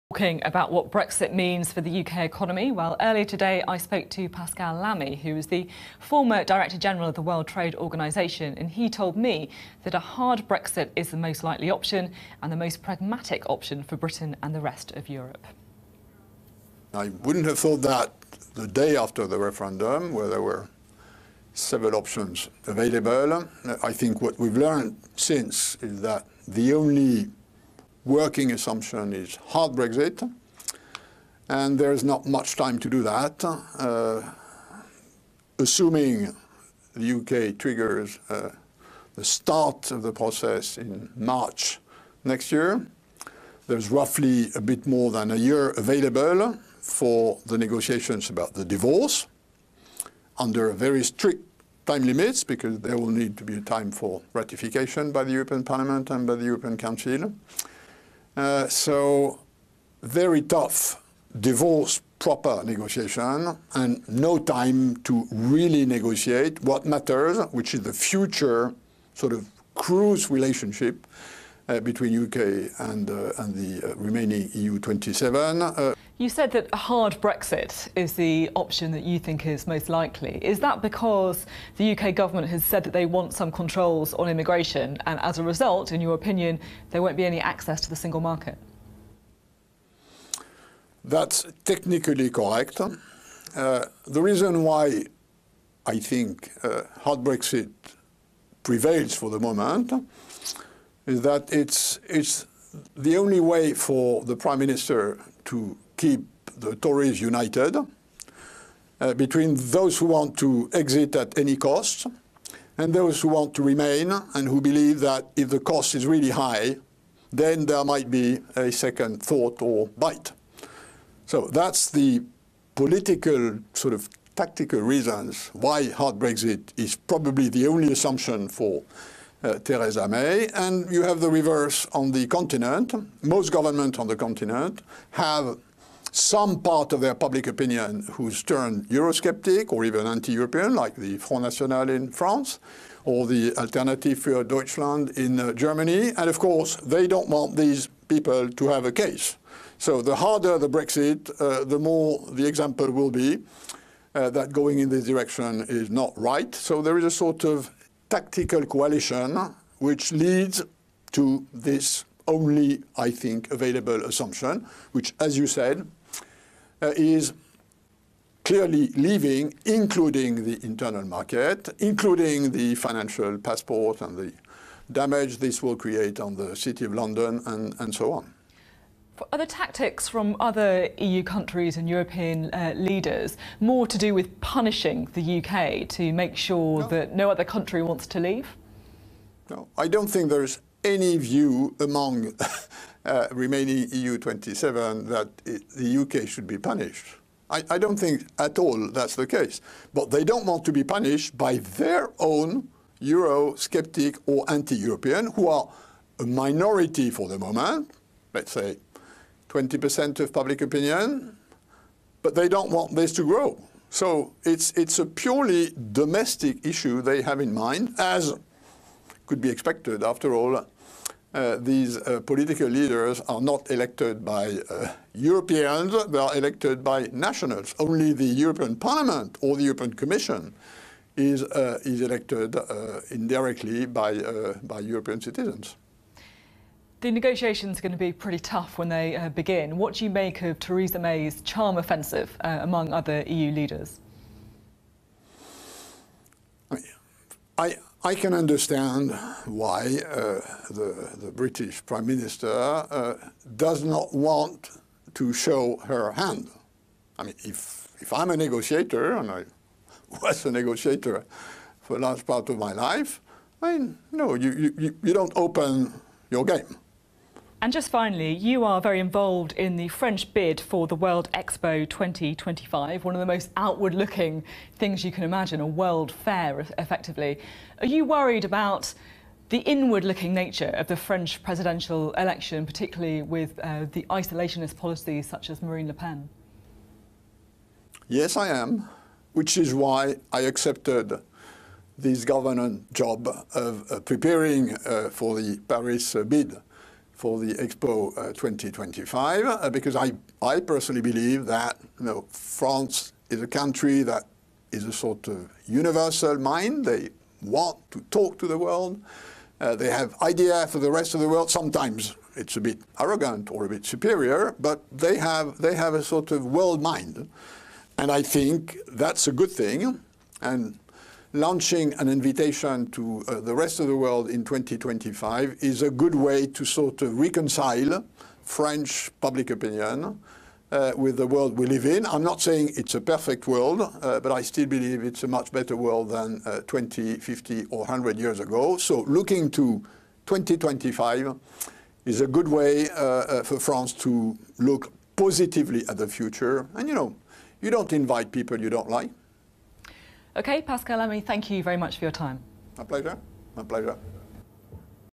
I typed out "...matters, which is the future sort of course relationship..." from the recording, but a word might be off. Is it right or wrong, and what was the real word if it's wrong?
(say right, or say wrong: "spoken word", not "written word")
wrong: "cruise", not "course".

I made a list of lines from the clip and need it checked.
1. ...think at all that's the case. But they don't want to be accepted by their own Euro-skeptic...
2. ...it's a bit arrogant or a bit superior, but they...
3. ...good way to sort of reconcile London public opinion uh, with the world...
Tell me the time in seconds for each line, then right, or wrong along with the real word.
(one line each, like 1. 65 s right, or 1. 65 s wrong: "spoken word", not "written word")
1. 197 s wrong: "punished", not "accepted"
2. 312 s right
3. 325 s wrong: "French", not "London".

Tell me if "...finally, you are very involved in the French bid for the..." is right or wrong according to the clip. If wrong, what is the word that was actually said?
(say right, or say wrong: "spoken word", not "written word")
right.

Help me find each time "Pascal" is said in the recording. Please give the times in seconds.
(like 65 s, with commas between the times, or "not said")
4 s, 350 s.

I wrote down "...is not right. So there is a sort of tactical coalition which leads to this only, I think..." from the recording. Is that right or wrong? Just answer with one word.
right.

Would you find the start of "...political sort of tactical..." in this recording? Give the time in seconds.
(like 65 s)
122 s.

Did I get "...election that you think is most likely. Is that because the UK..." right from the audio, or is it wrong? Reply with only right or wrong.
wrong.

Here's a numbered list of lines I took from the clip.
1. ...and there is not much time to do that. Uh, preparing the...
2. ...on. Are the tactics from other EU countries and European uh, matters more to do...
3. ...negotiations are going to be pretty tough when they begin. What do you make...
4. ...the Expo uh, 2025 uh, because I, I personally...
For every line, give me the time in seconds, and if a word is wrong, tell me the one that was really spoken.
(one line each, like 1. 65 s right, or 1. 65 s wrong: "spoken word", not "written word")
1. 31 s wrong: "assuming", not "preparing"
2. 178 s wrong: "leaders", not "matters"
3. 237 s right
4. 297 s right.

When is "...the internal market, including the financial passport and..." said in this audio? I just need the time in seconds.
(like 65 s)
170 s.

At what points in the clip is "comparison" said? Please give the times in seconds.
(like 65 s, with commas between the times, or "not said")
not said.